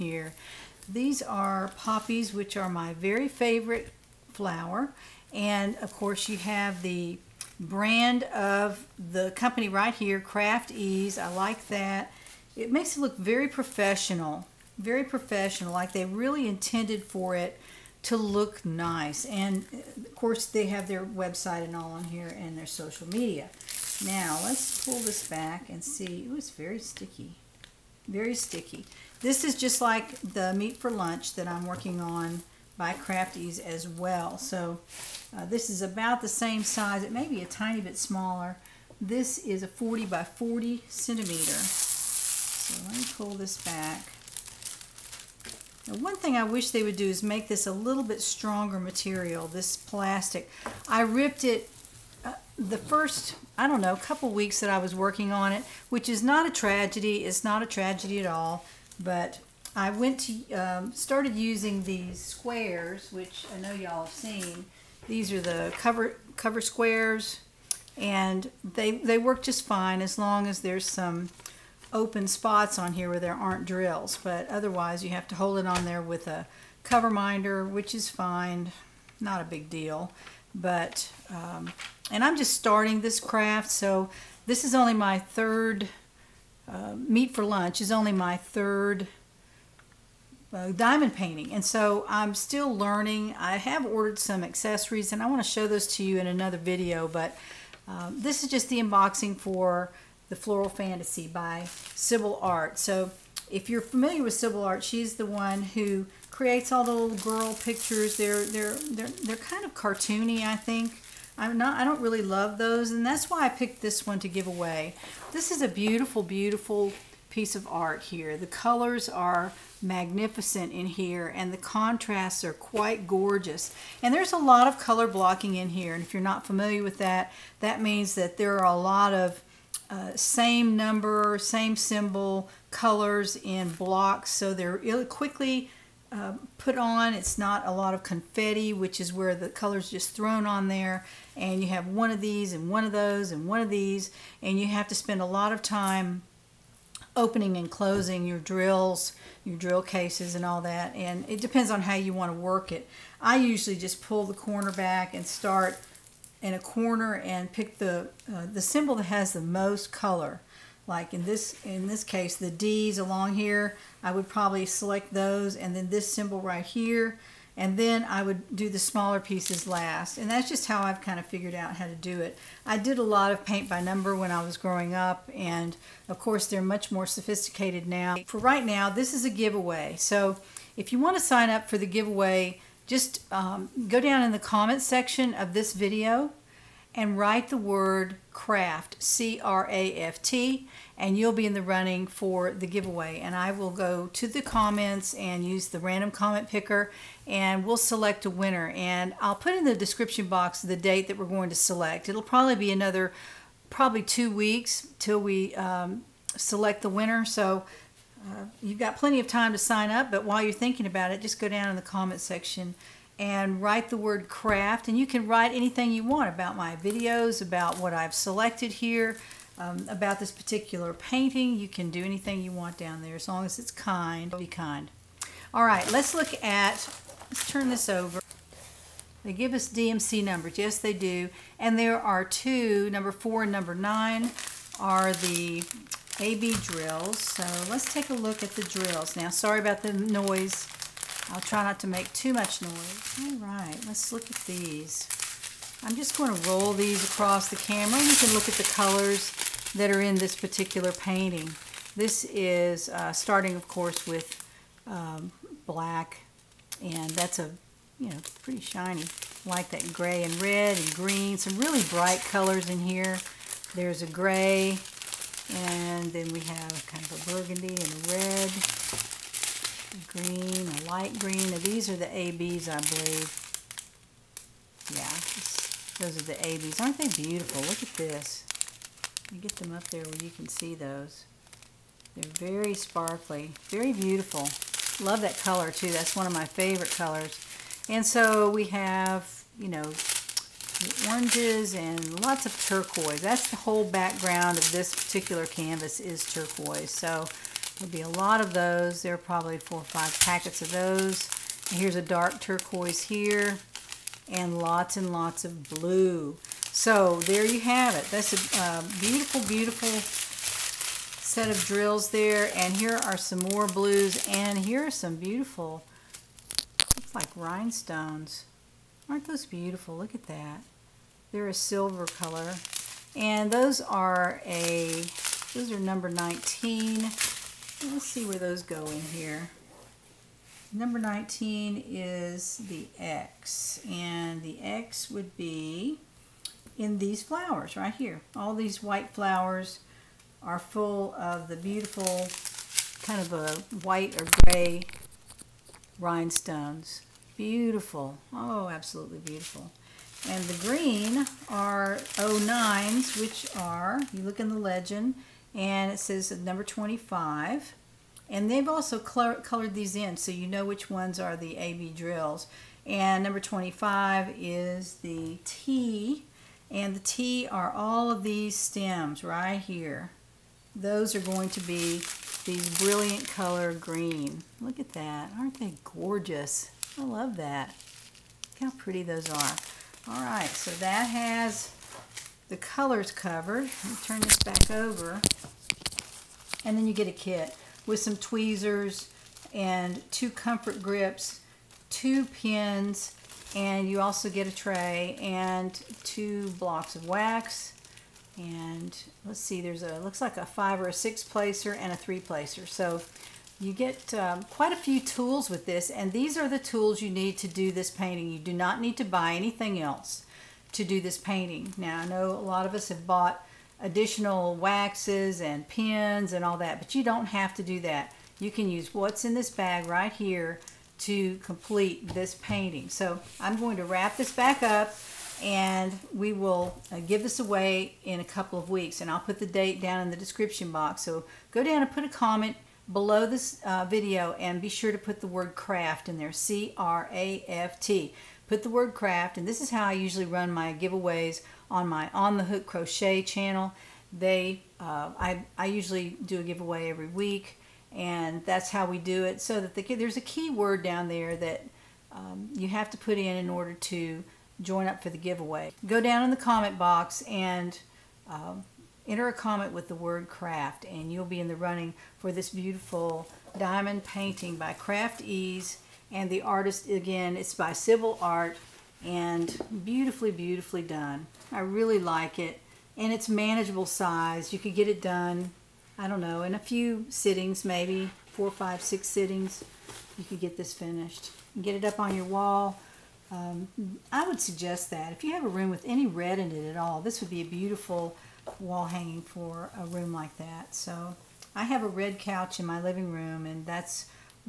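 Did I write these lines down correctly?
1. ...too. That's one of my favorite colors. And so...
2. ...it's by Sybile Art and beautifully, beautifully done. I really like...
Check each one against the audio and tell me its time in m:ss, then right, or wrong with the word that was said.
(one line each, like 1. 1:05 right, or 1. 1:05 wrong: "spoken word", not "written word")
1. 4:45 right
2. 7:47 right.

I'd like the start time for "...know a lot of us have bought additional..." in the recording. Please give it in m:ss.
6:52.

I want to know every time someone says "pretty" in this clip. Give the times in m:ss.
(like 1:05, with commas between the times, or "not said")
4:18, 6:18.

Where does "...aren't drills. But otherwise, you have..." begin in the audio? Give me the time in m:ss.
1:13.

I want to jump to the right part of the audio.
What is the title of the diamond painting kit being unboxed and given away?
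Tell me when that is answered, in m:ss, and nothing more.
1:40.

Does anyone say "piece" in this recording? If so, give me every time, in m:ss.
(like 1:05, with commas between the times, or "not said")
1:57, 2:49.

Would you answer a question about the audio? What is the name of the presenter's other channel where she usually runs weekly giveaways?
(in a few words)
On the Hook Crochet.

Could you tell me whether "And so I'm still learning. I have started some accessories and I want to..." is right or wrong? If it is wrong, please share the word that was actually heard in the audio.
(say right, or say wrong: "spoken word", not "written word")
wrong: "ordered", not "started".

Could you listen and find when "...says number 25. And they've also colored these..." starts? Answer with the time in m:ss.
5:55.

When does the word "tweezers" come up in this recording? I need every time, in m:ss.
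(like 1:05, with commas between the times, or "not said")
6:28.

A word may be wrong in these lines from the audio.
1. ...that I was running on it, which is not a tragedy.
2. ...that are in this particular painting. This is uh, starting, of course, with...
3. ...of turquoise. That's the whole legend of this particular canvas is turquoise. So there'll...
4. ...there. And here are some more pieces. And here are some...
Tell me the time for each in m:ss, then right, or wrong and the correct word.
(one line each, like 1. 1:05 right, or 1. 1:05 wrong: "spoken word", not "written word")
1. 0:54 wrong: "working", not "running"
2. 4:09 right
3. 4:52 wrong: "background", not "legend"
4. 5:12 wrong: "blues", not "pieces".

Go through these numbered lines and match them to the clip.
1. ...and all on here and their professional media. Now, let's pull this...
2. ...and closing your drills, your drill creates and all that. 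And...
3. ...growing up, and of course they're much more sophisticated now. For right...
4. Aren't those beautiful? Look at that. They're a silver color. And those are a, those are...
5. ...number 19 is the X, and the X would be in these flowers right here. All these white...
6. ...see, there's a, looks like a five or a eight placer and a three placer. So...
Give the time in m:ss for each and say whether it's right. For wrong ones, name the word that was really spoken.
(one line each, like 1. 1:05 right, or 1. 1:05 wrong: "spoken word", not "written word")
1. 0:21 wrong: "social", not "professional"
2. 2:27 wrong: "cases", not "creates"
3. 2:54 right
4. 5:19 right
5. 5:30 right
6. 6:39 wrong: "six", not "eight".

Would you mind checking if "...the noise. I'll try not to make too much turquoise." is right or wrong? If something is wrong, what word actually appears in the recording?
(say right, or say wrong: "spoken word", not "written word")
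wrong: "noise", not "turquoise".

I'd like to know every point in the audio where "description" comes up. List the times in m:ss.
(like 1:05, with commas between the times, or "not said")
3:19, 7:10.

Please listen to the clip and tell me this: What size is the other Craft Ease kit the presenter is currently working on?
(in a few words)
40 by 40 centimeters.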